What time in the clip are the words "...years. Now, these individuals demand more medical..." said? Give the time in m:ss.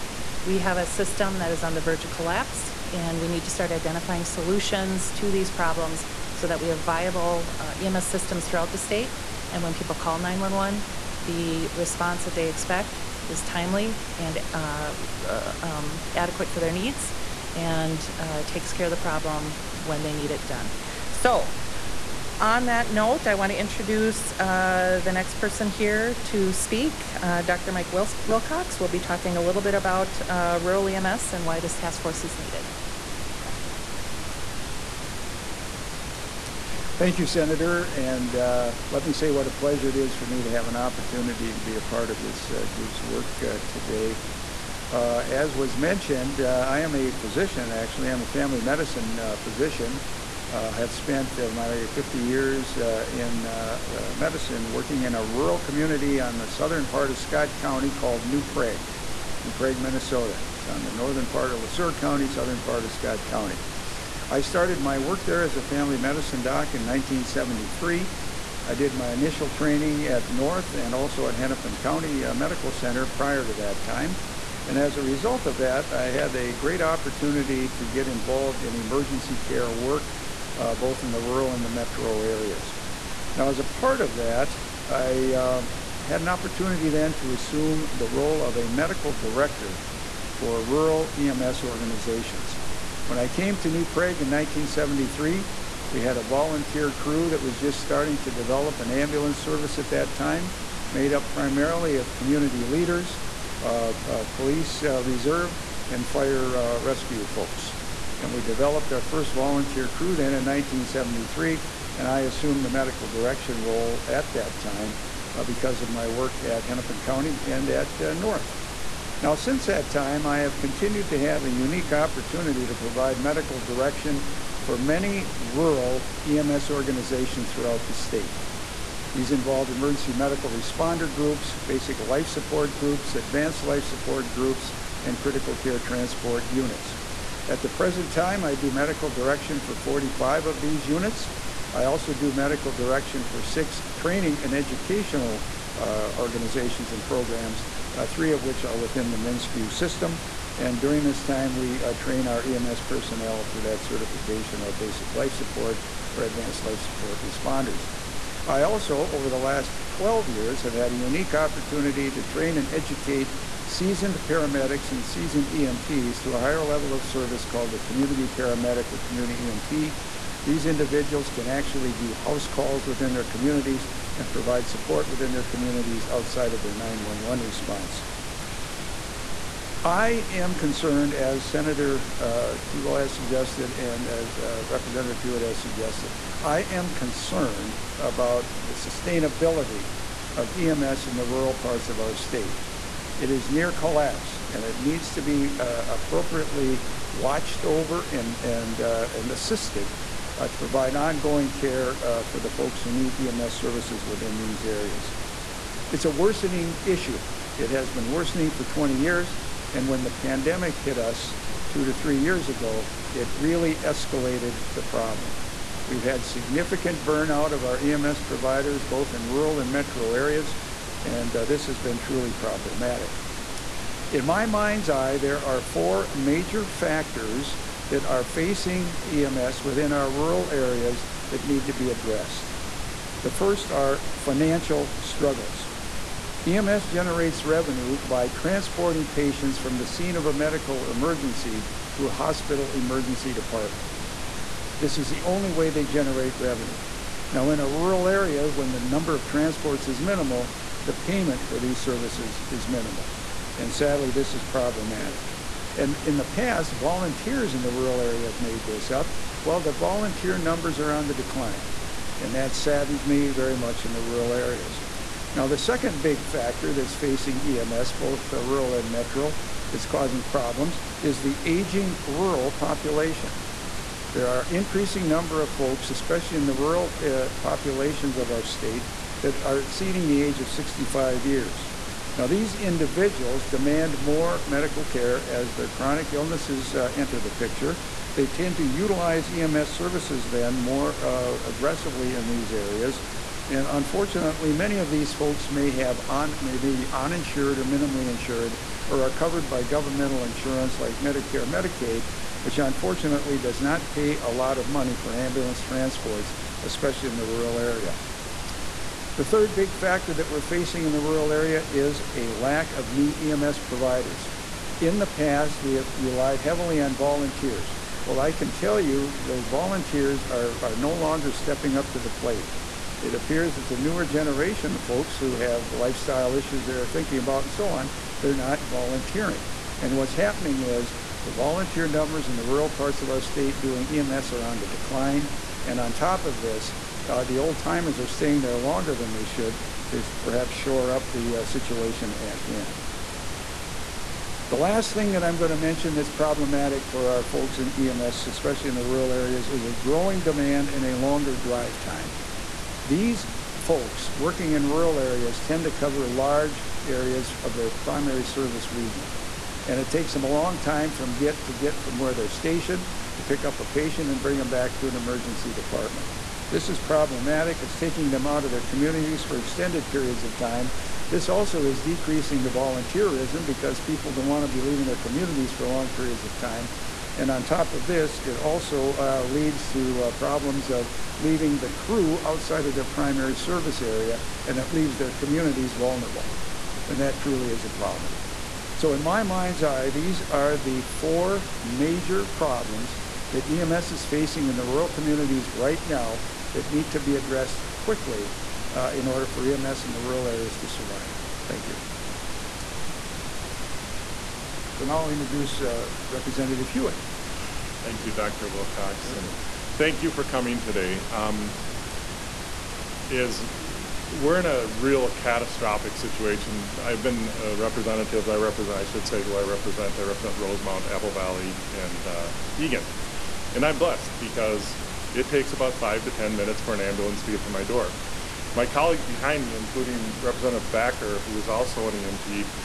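4:41.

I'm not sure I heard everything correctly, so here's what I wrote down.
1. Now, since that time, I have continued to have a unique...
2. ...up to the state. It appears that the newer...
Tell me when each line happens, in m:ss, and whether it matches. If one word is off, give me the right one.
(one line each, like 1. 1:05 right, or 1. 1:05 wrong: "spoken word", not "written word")
1. 1:59 right
2. 5:21 wrong: "plate", not "state".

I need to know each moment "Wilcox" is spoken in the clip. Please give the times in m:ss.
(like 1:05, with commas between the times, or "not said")
0:28, 6:48.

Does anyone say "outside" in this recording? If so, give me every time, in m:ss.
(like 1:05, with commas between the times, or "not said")
2:56, 6:22.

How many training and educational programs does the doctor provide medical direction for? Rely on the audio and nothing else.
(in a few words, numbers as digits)
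6.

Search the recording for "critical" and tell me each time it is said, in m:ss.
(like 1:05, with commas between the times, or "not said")
2:15.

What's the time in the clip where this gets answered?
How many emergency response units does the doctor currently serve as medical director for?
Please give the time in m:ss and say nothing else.
2:19.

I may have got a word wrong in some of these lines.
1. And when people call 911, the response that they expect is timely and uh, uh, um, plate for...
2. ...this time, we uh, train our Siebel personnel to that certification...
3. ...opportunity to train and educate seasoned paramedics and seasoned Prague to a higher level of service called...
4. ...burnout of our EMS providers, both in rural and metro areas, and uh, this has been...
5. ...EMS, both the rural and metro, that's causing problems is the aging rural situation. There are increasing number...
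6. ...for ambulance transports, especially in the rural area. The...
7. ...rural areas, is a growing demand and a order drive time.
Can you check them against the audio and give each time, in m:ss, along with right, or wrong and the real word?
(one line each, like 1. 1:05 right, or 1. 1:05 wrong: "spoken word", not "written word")
1. 0:09 wrong: "adequate", not "plate"
2. 2:31 wrong: "EMS", not "Siebel"
3. 2:41 wrong: "EMTs", not "Prague"
4. 3:37 right
5. 4:27 wrong: "population", not "situation"
6. 5:04 right
7. 5:48 wrong: "longer", not "order".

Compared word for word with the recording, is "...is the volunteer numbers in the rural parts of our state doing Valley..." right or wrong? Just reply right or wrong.
wrong.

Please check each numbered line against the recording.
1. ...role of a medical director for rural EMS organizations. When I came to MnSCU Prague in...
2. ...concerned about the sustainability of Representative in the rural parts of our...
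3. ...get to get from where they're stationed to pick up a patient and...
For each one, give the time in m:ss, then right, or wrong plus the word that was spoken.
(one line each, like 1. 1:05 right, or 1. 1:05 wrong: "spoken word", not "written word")
1. 1:28 wrong: "New", not "MnSCU"
2. 3:06 wrong: "EMS", not "Representative"
3. 6:01 right.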